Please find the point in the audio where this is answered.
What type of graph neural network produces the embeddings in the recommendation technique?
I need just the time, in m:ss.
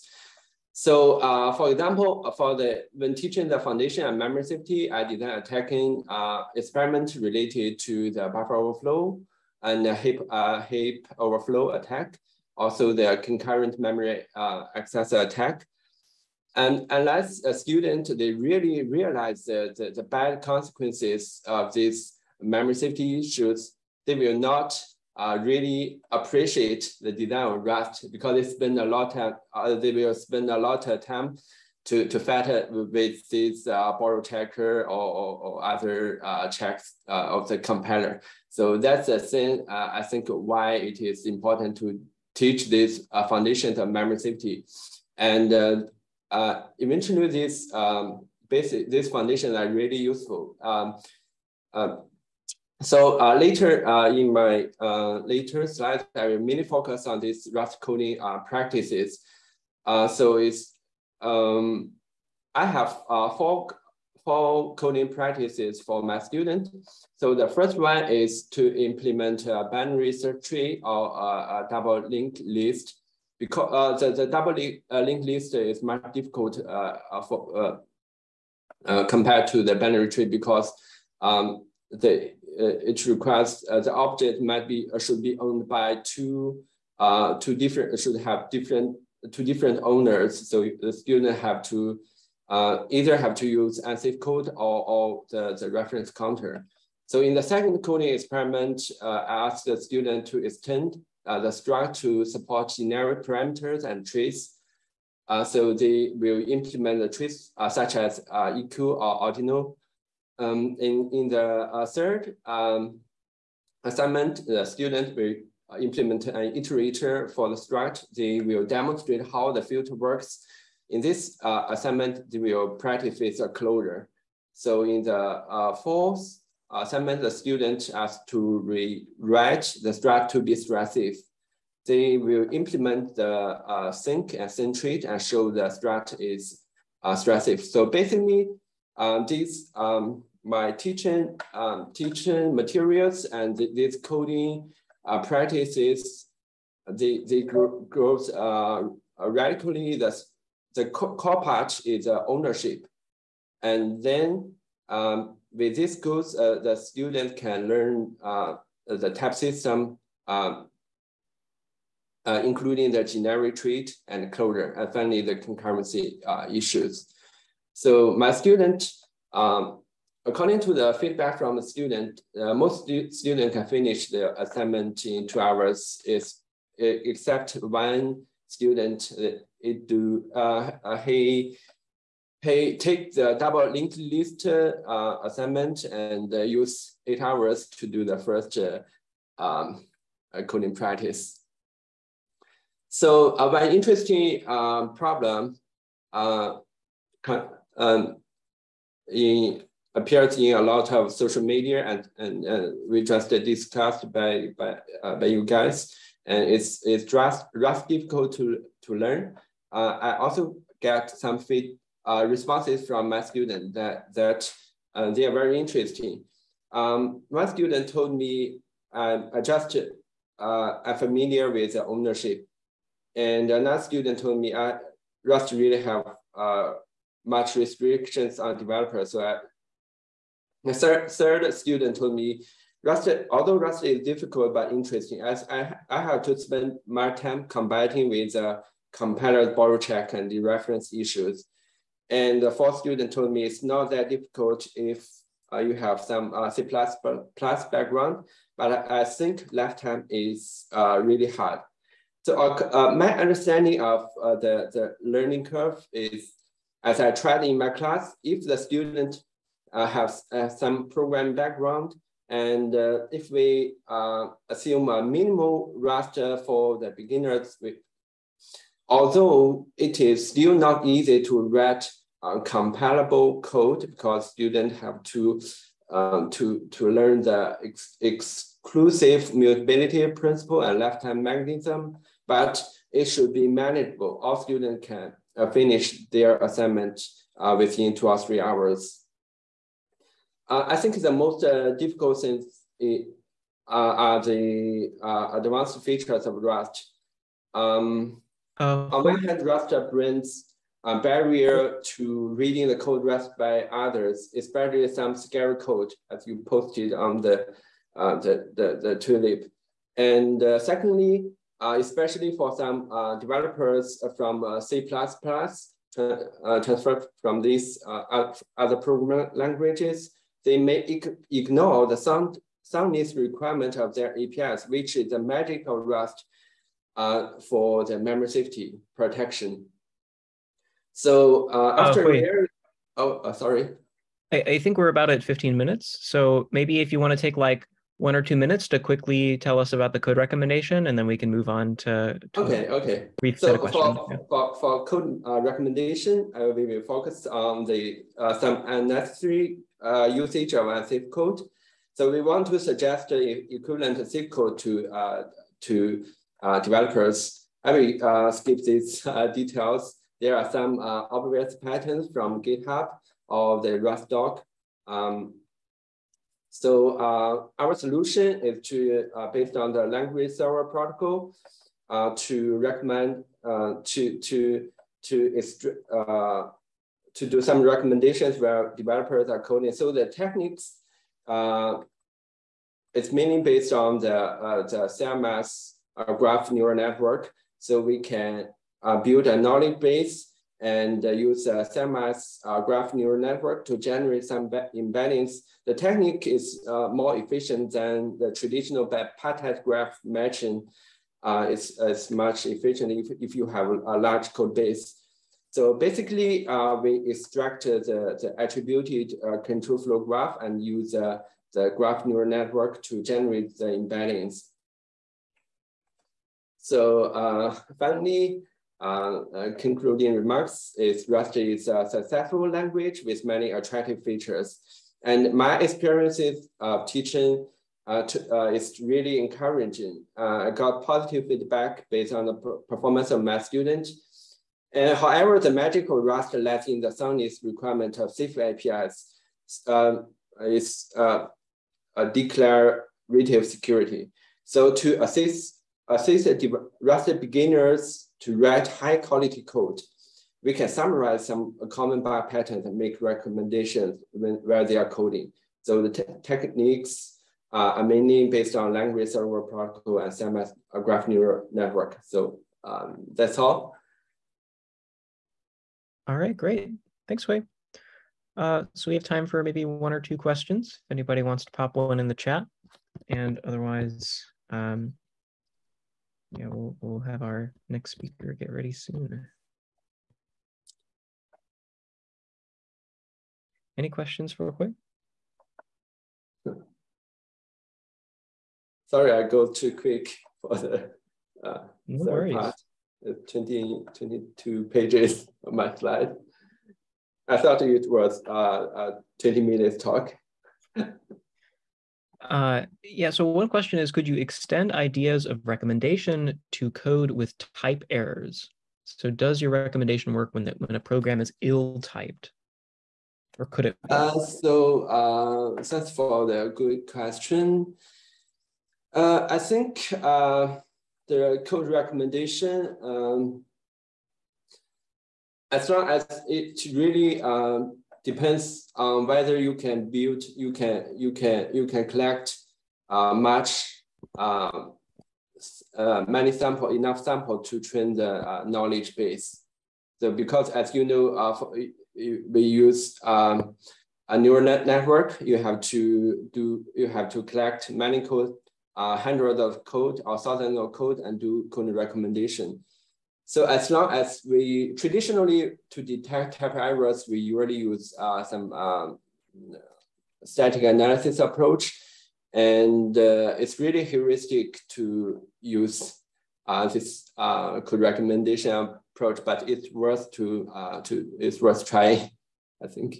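6:24.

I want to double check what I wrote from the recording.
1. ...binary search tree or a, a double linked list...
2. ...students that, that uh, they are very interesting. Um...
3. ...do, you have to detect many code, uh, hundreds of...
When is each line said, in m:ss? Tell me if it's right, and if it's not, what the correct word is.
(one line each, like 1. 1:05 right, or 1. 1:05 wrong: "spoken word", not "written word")
1. 1:09 right
2. 3:33 right
3. 9:06 wrong: "collect", not "detect".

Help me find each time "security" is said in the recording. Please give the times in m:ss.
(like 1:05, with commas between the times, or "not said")
7:23.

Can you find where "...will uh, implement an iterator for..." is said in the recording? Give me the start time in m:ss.
1:55.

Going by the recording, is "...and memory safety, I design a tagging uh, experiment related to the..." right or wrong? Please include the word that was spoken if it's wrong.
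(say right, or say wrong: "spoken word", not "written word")
right.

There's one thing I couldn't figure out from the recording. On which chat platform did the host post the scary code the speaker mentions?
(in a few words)
Zulip.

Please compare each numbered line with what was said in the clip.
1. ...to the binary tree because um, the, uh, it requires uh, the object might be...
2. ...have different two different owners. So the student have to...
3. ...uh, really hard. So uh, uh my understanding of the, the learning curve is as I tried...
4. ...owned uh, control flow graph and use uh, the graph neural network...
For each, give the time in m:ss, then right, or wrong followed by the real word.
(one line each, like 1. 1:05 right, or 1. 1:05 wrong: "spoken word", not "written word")
1. 1:19 right
2. 1:28 right
3. 4:10 right
4. 6:48 wrong: "attributed", not "owned".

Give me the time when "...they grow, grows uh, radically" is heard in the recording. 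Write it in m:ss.
2:27.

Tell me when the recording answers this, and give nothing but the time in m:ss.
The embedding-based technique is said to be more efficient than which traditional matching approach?
6:38.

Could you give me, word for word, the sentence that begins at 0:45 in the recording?
And eventually this um, basic, these foundations are really useful.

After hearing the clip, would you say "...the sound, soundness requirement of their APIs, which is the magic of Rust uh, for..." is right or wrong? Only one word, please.
right.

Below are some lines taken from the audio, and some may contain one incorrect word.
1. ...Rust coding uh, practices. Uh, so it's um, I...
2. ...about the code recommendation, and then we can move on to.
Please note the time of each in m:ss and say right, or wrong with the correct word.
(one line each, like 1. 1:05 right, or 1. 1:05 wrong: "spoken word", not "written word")
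1. 0:57 right
2. 5:39 right.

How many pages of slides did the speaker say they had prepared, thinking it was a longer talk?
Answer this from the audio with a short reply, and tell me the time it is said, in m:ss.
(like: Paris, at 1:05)
22, at 8:13.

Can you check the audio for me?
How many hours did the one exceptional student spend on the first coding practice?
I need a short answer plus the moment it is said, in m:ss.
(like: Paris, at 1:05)
8, at 3:07.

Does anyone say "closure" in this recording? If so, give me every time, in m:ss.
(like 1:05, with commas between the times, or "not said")
2:03, 2:44.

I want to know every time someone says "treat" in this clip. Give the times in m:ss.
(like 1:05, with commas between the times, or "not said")
2:43.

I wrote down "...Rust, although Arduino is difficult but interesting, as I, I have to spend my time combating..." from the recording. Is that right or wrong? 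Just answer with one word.
wrong.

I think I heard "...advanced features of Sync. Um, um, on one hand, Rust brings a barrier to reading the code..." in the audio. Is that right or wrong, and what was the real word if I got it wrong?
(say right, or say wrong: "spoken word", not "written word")
wrong: "Rust", not "Sync".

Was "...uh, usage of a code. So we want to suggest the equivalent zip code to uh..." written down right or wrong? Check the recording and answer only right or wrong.
right.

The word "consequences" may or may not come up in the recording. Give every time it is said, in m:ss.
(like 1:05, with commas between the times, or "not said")
0:20.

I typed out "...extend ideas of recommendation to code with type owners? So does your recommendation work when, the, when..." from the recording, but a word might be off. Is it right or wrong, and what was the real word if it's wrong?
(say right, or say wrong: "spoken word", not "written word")
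wrong: "errors", not "owners".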